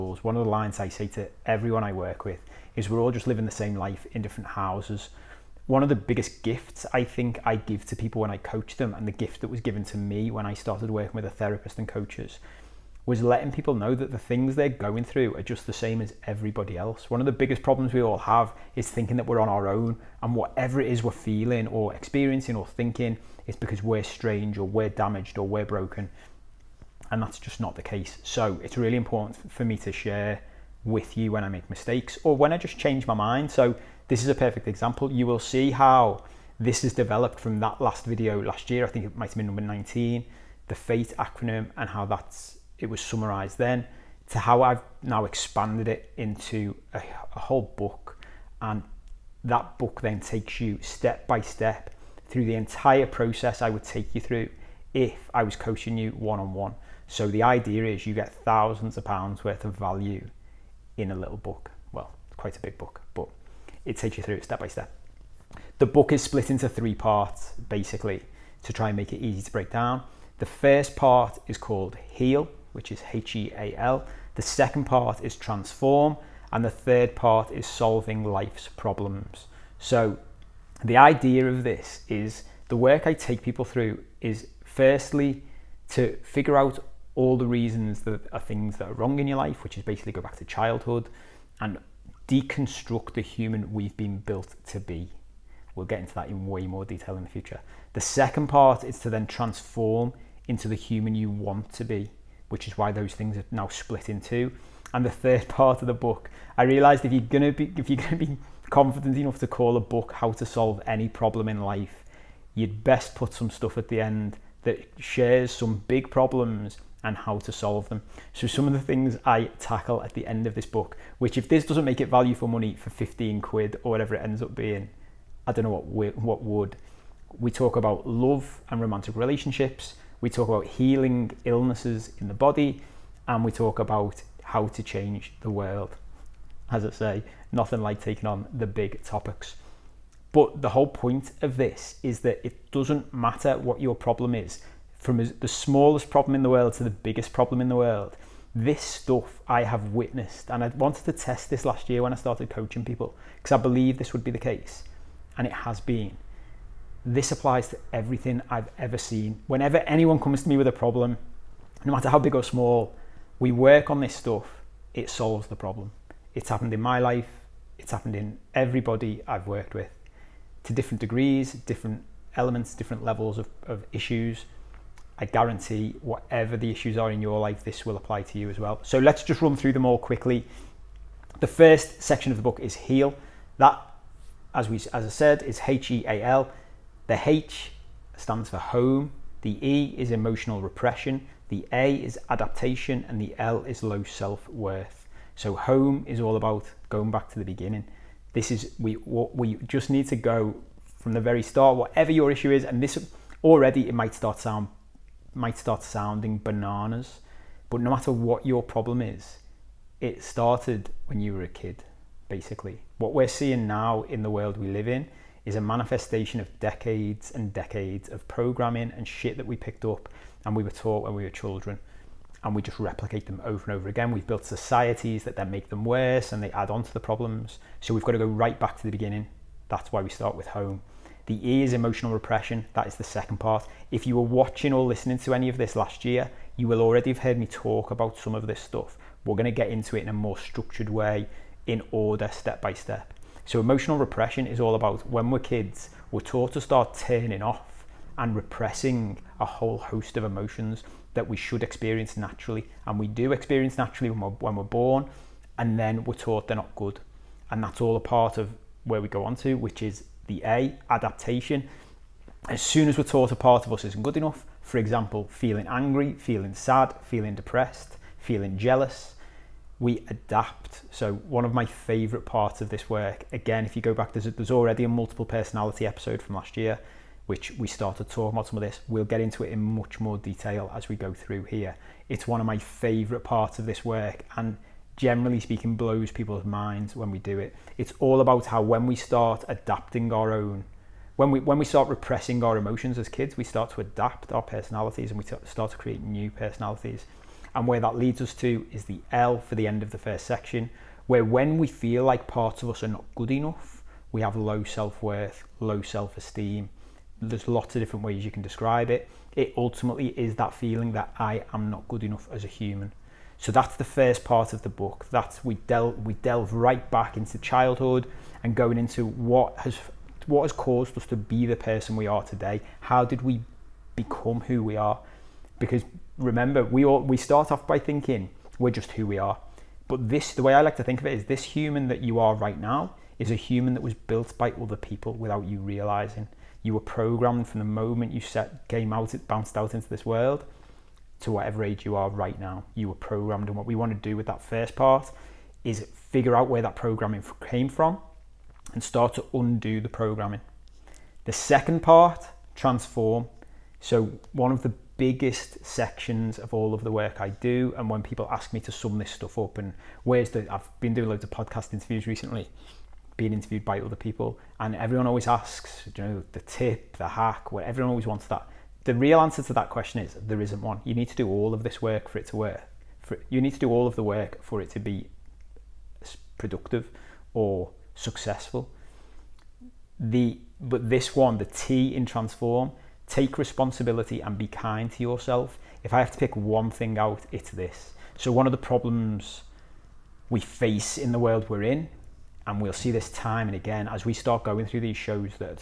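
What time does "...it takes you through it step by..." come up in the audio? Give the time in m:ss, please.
1:03.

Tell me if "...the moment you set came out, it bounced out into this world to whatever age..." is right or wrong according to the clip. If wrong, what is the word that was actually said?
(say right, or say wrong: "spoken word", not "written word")
right.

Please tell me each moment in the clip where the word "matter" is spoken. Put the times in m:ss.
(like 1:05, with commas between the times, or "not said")
2:23, 2:41, 3:27.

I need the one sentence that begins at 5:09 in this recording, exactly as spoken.
It ultimately is that feeling that I am not good enough as a human so that's the first part of the book.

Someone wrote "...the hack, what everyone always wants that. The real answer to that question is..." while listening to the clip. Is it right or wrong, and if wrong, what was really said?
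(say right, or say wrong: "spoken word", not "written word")
right.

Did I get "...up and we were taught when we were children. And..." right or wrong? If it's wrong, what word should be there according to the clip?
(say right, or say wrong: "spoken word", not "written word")
right.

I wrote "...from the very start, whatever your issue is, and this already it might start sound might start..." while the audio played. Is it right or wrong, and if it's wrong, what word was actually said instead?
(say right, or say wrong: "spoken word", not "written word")
right.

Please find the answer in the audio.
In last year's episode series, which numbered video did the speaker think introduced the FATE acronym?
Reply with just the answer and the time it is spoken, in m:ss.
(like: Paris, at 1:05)
19, at 0:39.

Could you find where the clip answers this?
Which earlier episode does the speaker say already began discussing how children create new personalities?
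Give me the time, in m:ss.
4:34.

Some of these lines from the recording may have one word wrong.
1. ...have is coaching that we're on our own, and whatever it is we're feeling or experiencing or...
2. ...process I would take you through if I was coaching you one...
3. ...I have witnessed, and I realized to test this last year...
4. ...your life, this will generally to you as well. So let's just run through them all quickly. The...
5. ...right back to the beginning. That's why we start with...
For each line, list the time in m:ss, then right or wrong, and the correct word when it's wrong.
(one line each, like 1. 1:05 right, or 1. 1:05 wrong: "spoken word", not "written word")
1. 0:18 wrong: "thinking", not "coaching"
2. 0:53 right
3. 2:29 wrong: "wanted", not "realized"
4. 2:57 wrong: "apply", not "generally"
5. 3:48 right.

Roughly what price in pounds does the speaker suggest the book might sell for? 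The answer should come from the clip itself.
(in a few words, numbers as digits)
15 quid.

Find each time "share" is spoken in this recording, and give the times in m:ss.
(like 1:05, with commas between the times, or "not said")
0:29, 1:54.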